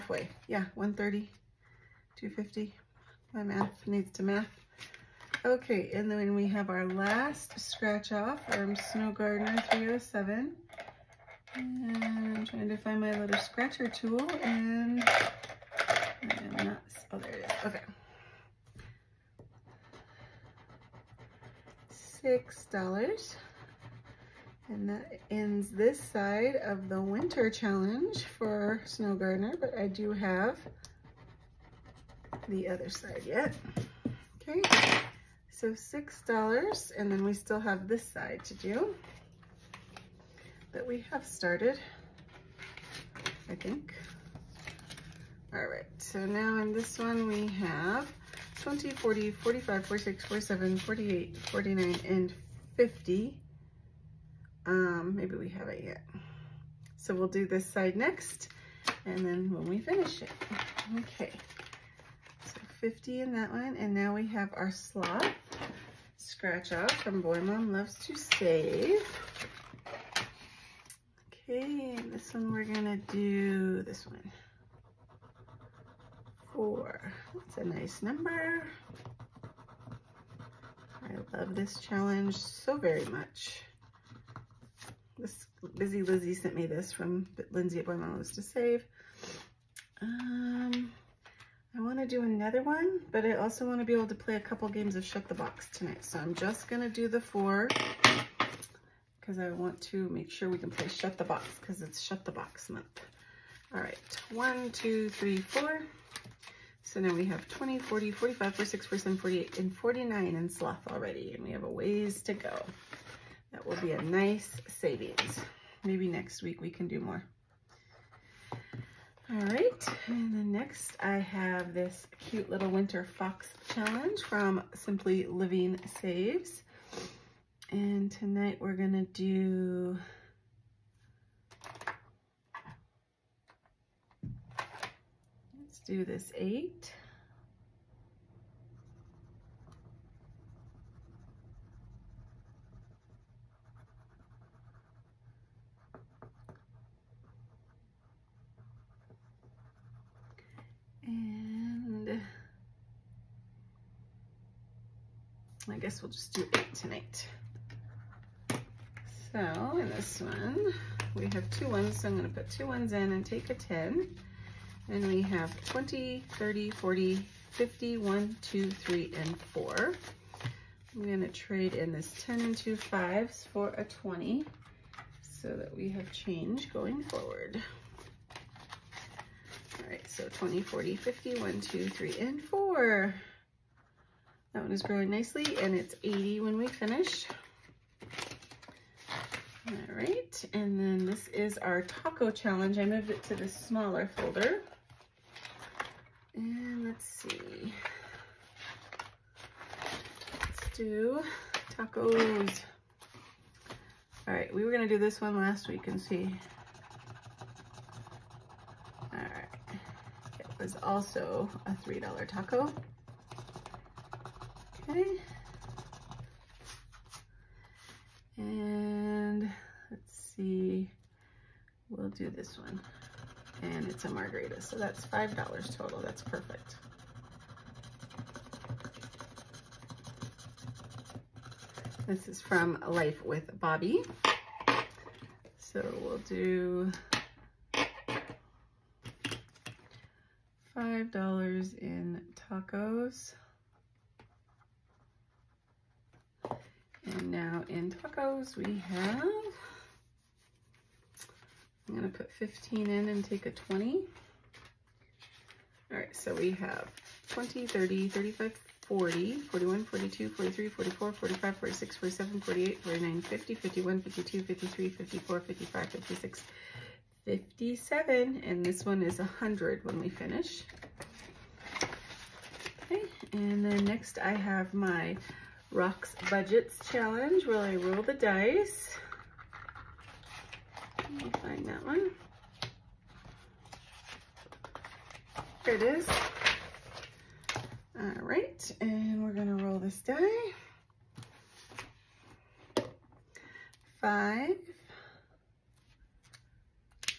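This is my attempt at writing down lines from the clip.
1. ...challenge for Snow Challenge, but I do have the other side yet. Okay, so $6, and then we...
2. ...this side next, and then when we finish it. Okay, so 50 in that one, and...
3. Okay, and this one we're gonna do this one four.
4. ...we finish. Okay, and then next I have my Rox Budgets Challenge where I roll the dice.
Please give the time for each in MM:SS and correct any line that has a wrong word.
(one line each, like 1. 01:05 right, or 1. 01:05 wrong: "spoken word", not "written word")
1. 00:27 wrong: "Gardener", not "Challenge"
2. 00:57 right
3. 01:11 right
4. 04:30 right.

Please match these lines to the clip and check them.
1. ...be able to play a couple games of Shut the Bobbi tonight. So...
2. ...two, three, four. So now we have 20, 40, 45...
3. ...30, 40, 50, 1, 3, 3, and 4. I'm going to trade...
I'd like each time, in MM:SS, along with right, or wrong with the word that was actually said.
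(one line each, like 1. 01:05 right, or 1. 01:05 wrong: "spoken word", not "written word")
1. 01:33 wrong: "Box", not "Bobbi"
2. 01:44 right
3. 02:46 wrong: "2", not "3".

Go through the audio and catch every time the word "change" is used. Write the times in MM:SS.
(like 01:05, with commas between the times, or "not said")
02:56.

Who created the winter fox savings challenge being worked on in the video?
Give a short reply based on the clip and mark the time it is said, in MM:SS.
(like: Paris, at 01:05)
Simply Living Saves, at 02:04.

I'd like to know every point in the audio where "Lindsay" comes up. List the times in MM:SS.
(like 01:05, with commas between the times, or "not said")
01:27.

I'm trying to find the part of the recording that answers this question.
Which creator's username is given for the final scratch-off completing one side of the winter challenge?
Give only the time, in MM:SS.
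00:08.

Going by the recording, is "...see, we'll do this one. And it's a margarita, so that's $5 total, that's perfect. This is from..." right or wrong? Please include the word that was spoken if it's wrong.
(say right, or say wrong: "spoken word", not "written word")
right.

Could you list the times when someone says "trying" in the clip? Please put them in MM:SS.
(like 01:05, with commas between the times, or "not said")
00:12.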